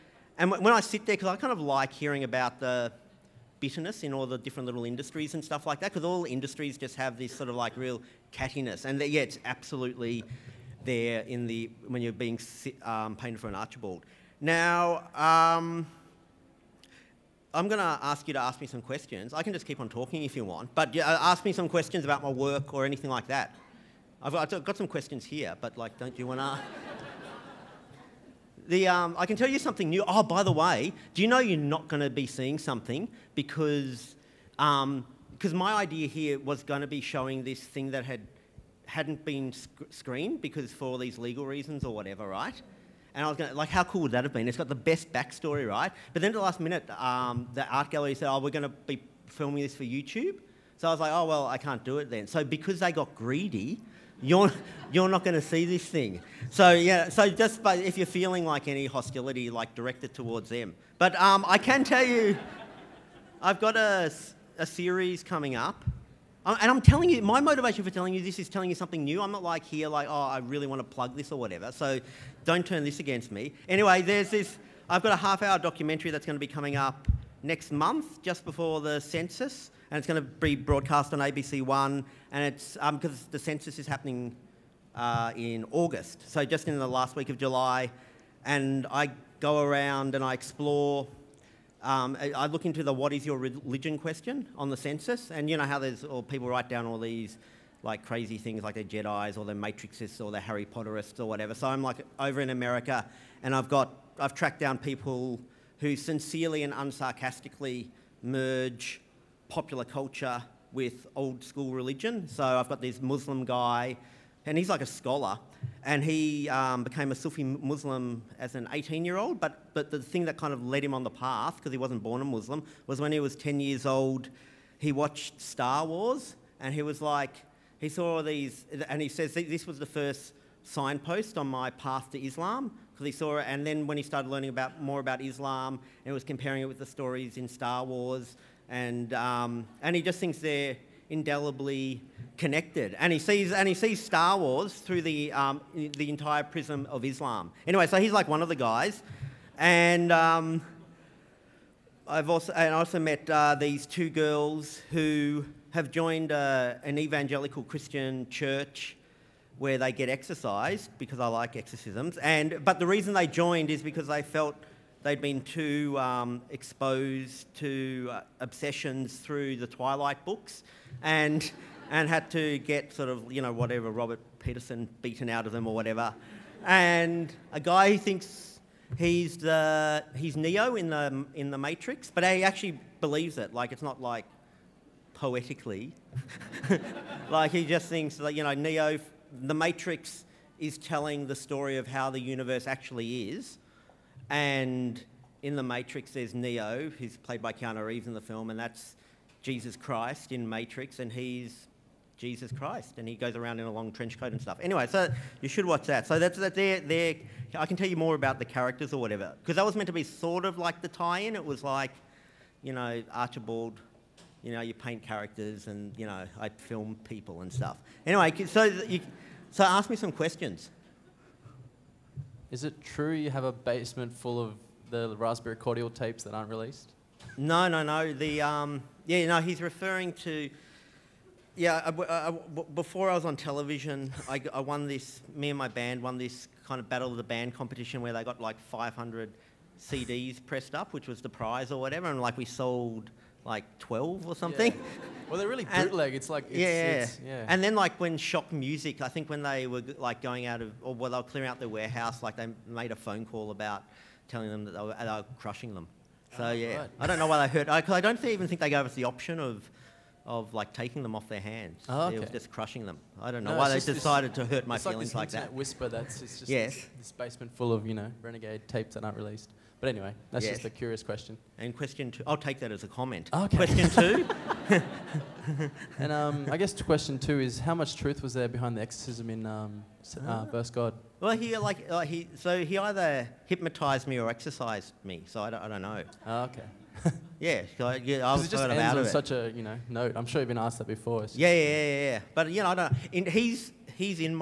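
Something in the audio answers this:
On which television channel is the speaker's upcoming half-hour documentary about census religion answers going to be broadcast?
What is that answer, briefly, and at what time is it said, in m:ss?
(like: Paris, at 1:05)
ABC One, at 1:21.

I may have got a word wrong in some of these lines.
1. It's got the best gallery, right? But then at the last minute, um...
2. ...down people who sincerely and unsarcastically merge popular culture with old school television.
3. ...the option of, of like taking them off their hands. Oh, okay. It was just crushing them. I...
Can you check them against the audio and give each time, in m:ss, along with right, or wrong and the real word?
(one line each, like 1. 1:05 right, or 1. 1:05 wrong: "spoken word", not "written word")
1. 0:44 wrong: "backstory", not "gallery"
2. 1:44 wrong: "religion", not "television"
3. 4:18 right.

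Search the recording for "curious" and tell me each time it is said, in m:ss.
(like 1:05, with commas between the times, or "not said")
4:30.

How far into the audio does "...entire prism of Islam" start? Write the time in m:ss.
2:26.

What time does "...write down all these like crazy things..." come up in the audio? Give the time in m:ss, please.
1:36.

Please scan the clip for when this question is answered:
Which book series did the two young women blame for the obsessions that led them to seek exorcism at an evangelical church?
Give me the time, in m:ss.
2:49.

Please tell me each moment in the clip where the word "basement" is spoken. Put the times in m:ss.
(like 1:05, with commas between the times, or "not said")
3:43, 4:27.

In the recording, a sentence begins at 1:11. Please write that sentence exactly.
So don't turn this against me.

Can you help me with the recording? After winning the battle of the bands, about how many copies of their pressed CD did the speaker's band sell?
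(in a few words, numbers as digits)
12.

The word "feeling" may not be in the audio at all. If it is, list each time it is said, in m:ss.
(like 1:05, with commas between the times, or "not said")
0:58, 4:24.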